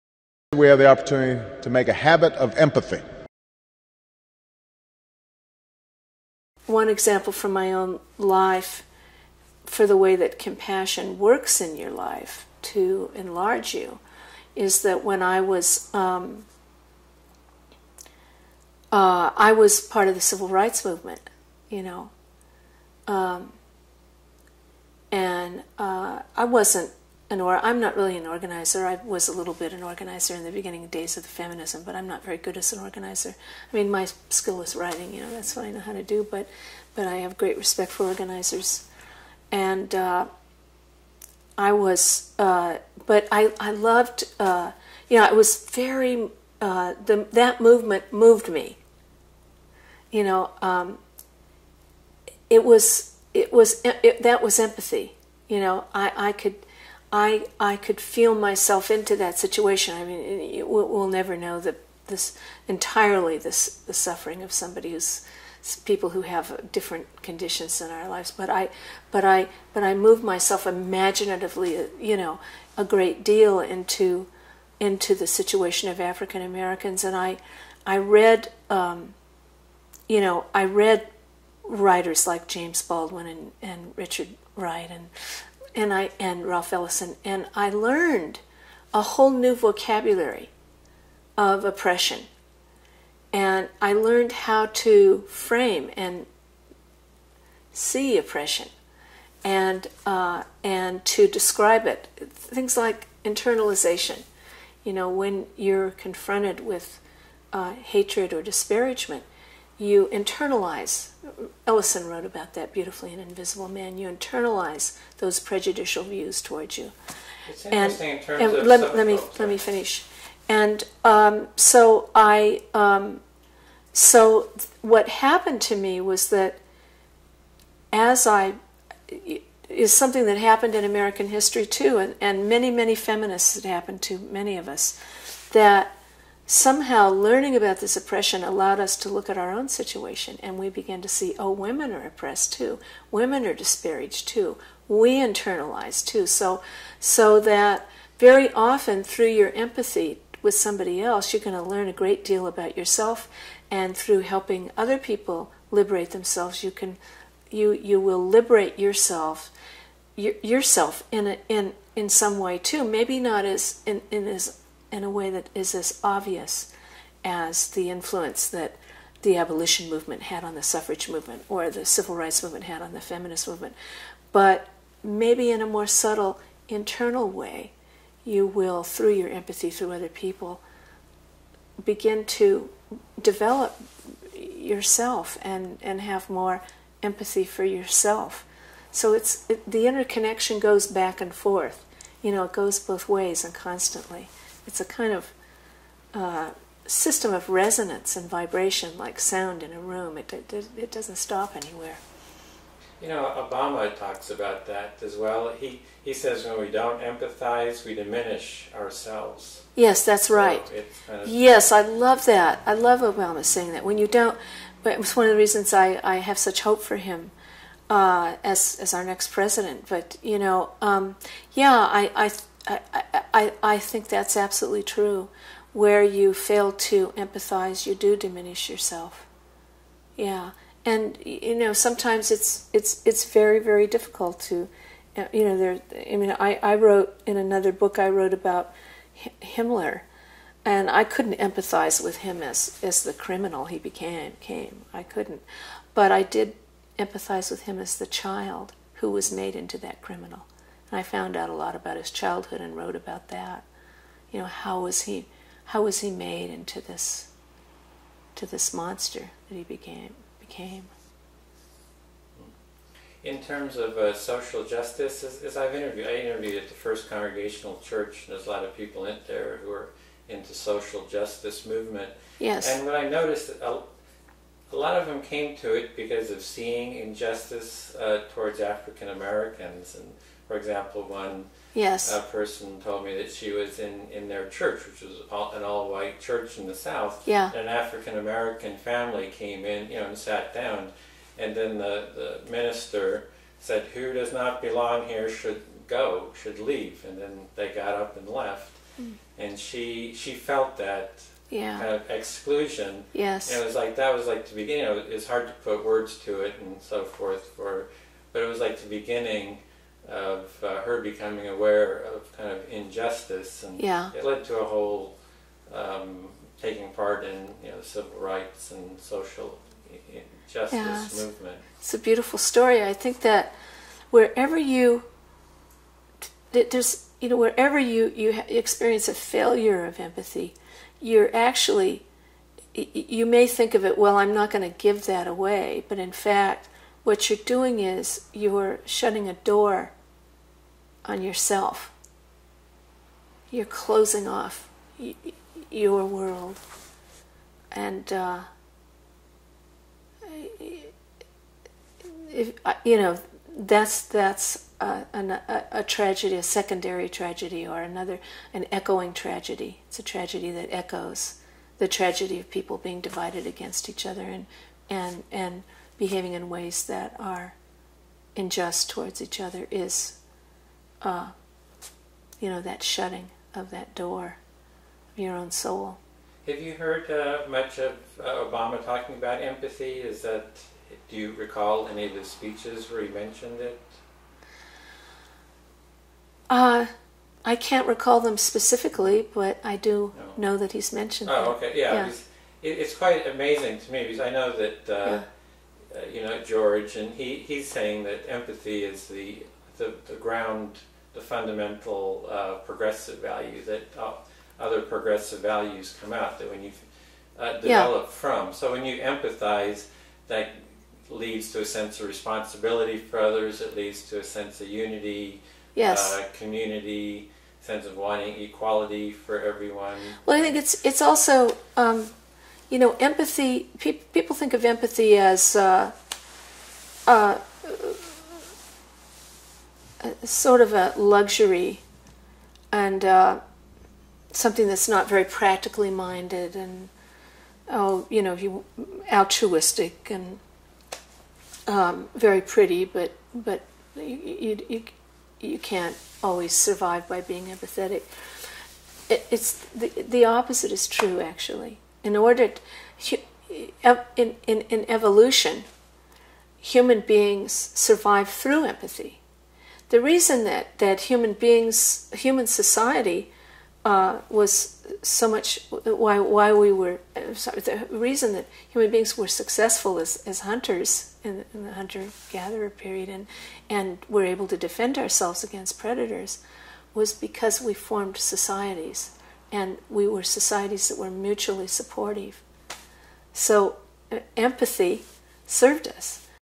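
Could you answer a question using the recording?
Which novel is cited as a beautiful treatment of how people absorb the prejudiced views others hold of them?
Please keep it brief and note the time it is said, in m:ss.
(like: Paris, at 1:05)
Invisible Man, at 1:53.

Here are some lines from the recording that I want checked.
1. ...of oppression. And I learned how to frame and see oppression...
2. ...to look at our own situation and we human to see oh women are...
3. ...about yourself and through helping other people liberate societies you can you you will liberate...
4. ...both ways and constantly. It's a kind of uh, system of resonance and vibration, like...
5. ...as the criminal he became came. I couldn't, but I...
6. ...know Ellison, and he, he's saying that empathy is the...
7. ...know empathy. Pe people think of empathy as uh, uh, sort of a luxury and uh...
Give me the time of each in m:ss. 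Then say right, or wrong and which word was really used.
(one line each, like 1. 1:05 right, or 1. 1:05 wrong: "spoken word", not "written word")
1. 1:31 right
2. 2:18 wrong: "began", not "human"
3. 2:32 wrong: "themselves", not "societies"
4. 3:12 right
5. 4:02 right
6. 6:36 wrong: "George", not "Ellison"
7. 7:02 right.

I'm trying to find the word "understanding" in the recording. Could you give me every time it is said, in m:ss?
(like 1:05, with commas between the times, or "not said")
not said.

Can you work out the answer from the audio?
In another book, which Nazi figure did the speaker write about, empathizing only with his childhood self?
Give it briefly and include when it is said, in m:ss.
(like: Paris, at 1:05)
Himmler, at 3:59.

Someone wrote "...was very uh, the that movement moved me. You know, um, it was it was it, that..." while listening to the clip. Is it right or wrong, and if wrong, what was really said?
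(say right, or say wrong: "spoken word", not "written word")
right.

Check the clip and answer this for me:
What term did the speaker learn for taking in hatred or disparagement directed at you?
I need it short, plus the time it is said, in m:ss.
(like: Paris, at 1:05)
internalization, at 1:43.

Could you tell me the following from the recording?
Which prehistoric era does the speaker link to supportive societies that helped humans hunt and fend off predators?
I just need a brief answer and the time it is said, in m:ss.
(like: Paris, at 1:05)
hunter gatherer period, at 7:51.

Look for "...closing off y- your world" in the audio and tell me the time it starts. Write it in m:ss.
5:43.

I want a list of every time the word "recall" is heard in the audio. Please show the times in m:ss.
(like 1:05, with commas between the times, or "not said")
6:21, 6:27.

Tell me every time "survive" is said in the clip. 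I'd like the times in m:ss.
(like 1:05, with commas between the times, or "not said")
7:26, 7:37.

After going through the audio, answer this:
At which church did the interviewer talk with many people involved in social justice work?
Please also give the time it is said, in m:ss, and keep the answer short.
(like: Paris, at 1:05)
First Congregational Church, at 4:26.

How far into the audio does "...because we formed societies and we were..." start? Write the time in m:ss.
7:57.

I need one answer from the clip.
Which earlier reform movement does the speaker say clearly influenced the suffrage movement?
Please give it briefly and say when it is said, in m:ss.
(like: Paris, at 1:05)
abolition movement, at 2:49.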